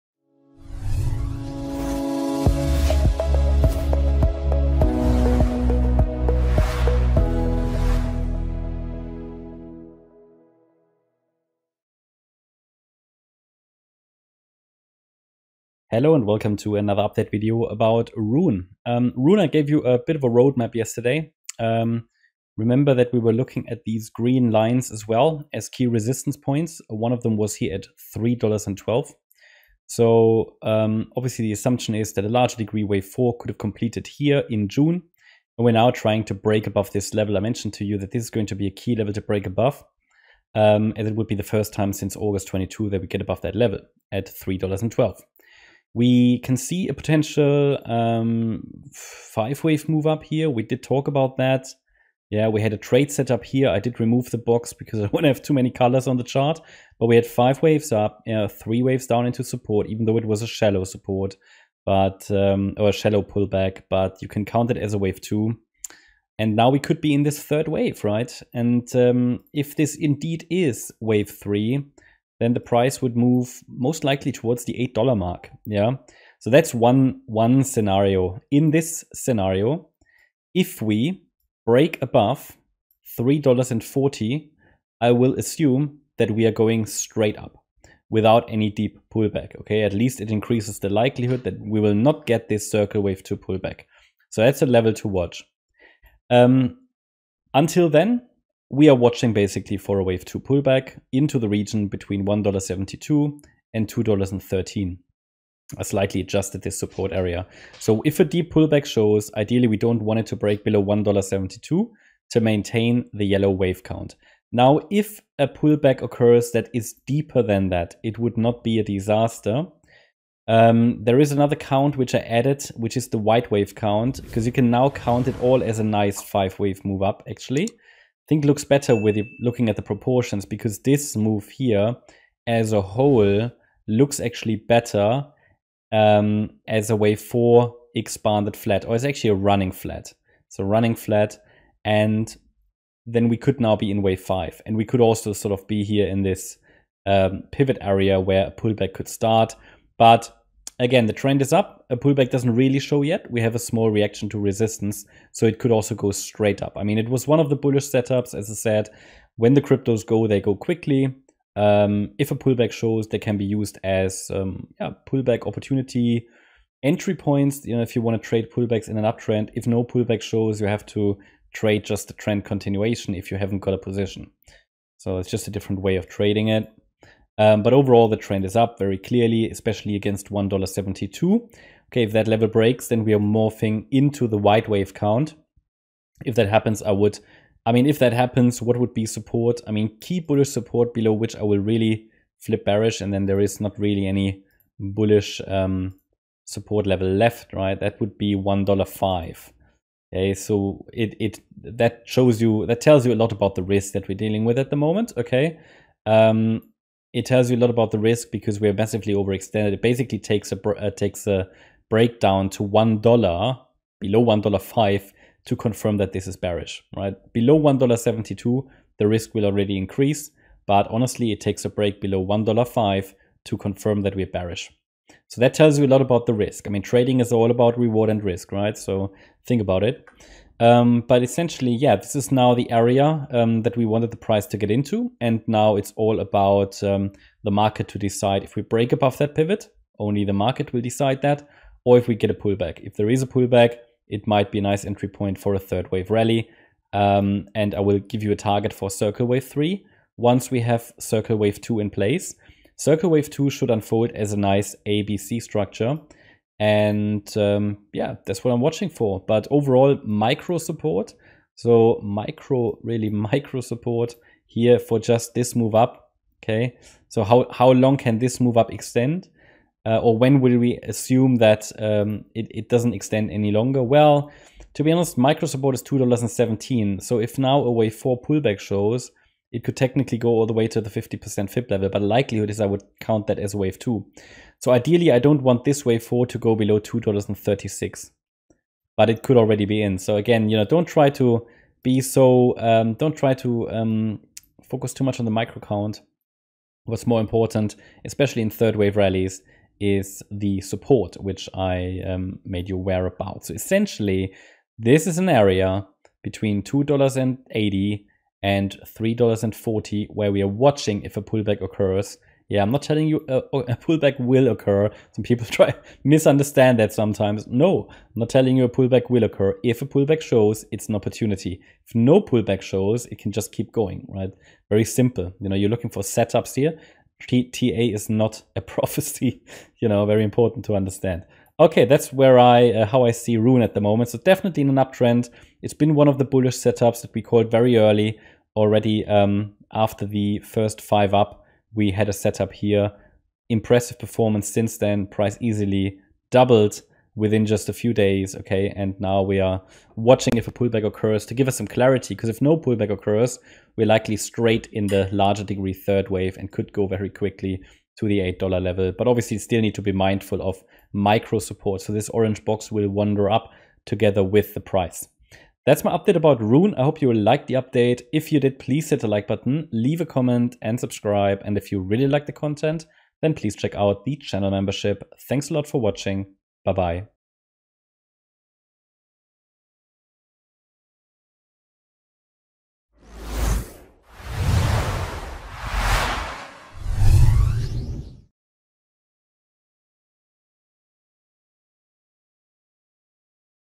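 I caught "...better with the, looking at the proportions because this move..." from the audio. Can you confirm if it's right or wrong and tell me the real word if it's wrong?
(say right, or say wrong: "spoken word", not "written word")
right.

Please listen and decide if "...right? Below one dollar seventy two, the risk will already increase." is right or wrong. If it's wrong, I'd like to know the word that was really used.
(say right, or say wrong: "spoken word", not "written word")
right.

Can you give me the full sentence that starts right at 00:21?
Um, remember that we were looking at these green lines as well as key resistance points.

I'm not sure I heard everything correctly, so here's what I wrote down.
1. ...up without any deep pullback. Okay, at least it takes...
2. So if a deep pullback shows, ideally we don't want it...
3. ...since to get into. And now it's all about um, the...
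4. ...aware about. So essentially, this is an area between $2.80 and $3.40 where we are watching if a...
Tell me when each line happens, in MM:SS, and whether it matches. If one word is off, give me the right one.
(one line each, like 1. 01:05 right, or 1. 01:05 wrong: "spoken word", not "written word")
1. 01:27 wrong: "increases", not "takes"
2. 01:47 right
3. 03:54 wrong: "price", not "since"
4. 05:02 right.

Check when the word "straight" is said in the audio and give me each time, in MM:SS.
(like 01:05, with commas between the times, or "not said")
01:26, 02:36, 05:54.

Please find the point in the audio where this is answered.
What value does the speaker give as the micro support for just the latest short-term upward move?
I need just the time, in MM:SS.
04:35.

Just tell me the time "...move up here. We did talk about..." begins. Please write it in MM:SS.
00:49.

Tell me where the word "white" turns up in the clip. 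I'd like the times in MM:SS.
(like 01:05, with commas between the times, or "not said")
02:03, 03:04.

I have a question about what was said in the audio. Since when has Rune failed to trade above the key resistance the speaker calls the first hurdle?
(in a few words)
August 22.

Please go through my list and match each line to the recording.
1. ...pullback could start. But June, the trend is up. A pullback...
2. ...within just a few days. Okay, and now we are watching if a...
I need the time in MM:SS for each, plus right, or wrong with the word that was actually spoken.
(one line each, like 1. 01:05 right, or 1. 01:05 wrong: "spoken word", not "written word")
1. 02:28 wrong: "Again", not "June"
2. 05:47 right.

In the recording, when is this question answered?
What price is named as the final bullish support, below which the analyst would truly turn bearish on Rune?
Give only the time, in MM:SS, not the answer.
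03:18.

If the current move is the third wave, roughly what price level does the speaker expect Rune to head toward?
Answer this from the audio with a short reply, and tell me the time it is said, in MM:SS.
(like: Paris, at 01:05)
$8, at 01:14.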